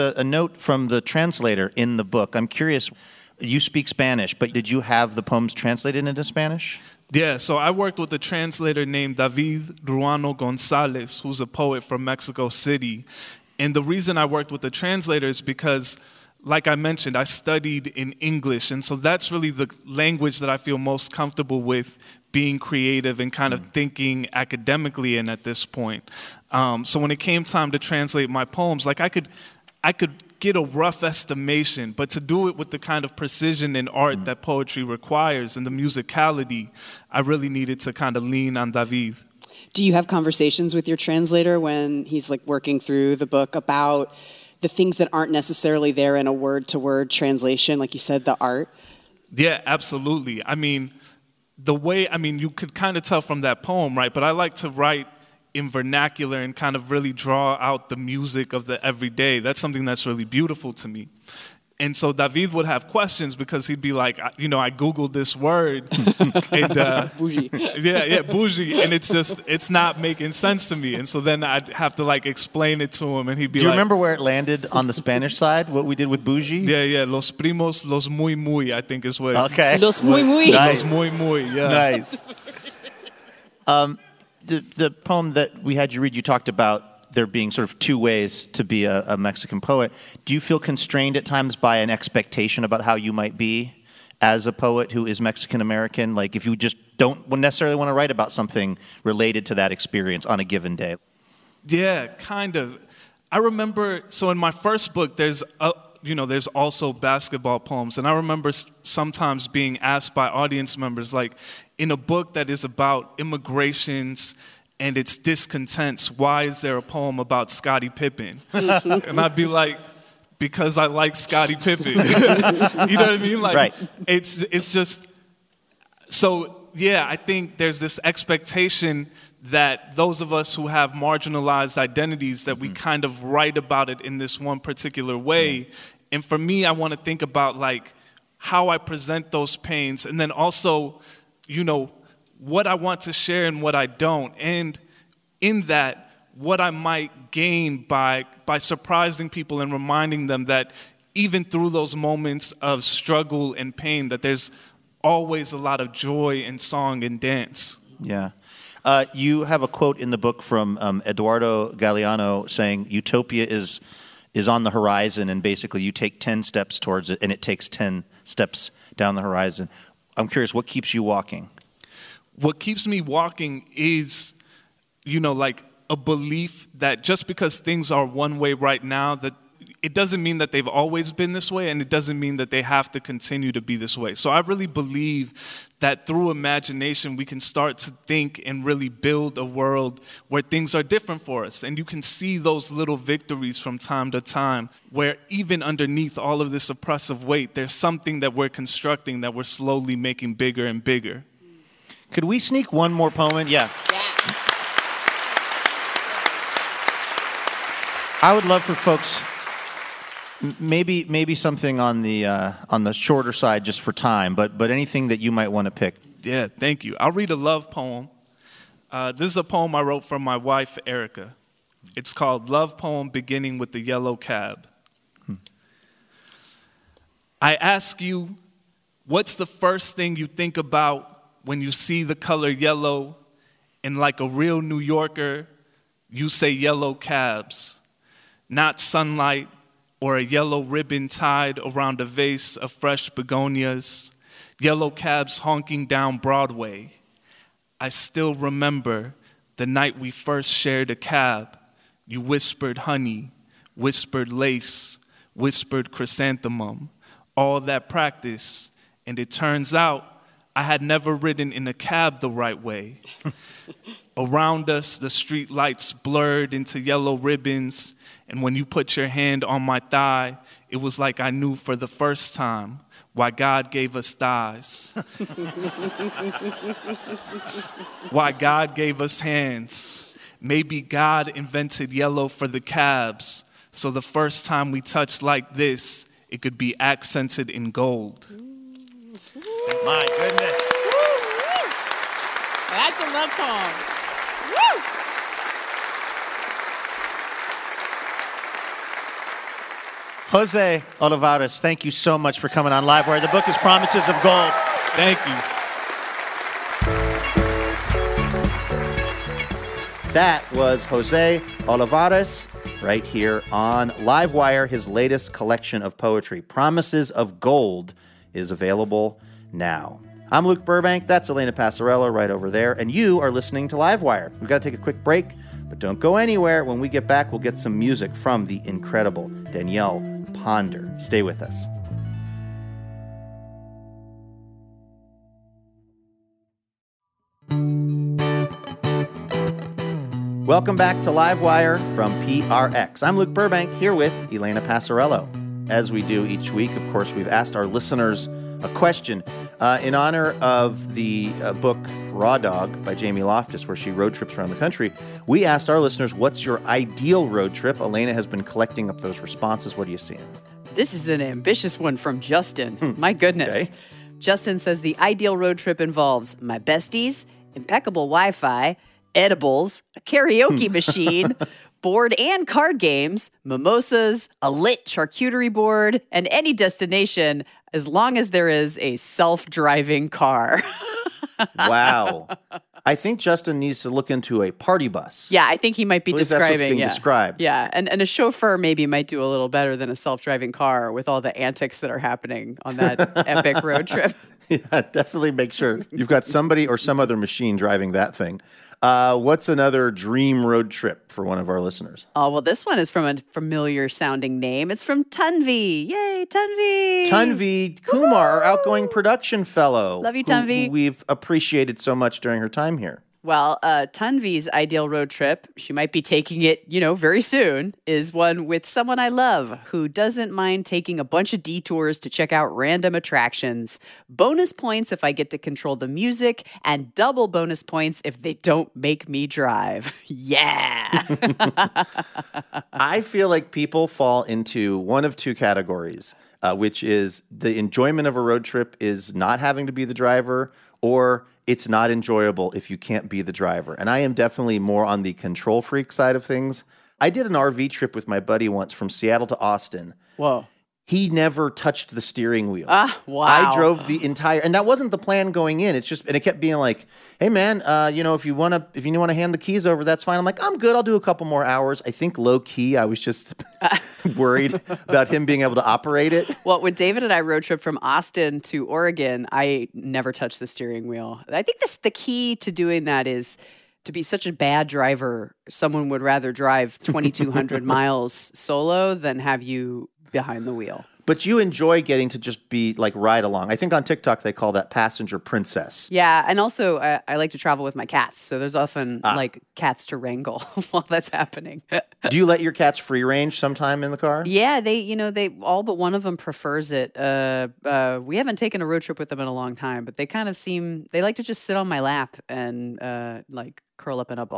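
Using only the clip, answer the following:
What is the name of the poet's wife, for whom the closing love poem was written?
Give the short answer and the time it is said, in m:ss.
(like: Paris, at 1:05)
Erica, at 3:40.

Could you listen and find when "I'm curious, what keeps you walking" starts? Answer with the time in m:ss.
2:50.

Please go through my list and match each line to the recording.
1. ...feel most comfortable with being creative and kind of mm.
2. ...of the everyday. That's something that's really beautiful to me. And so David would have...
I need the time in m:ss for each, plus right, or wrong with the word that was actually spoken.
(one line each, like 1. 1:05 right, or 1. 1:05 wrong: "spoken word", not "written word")
1. 0:20 right
2. 0:58 right.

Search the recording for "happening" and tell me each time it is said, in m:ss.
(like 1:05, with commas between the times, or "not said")
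6:31, 8:11.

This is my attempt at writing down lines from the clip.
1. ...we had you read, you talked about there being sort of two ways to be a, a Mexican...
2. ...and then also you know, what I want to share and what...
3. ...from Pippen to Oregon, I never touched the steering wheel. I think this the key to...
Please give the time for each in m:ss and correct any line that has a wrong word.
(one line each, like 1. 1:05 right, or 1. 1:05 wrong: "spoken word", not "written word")
1. 1:25 right
2. 2:20 right
3. 7:47 wrong: "Austin", not "Pippen".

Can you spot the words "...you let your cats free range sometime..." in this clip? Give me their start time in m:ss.
8:12.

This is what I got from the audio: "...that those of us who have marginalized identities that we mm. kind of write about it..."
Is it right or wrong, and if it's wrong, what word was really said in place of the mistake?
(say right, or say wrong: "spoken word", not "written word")
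right.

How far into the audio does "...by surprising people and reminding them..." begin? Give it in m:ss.
2:28.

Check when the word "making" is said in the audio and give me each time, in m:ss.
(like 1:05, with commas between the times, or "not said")
1:09, 3:19.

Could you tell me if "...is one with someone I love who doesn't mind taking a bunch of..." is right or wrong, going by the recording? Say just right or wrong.
right.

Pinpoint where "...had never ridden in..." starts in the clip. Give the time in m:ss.
4:20.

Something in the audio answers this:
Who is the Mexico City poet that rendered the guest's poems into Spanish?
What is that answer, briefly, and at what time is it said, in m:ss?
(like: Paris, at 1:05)
David Ruano Gonzalez, at 0:09.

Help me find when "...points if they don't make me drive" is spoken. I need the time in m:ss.
7:07.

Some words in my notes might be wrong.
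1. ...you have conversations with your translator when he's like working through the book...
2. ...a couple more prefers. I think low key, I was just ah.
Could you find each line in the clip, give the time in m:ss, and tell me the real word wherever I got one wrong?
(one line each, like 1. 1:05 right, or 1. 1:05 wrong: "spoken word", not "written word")
1. 0:39 right
2. 7:40 wrong: "hours", not "prefers".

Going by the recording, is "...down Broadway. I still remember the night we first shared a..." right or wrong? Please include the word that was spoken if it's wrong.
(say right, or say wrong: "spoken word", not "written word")
right.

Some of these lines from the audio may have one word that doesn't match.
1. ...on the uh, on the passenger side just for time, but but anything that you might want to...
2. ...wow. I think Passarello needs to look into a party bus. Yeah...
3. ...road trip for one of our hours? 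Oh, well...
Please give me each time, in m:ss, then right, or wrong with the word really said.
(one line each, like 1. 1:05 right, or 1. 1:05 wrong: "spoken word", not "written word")
1. 3:31 wrong: "shorter", not "passenger"
2. 6:21 wrong: "Justin", not "Passarello"
3. 6:40 wrong: "listeners", not "hours".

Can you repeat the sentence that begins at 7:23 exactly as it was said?
And I am definitely more on the control freak side of things.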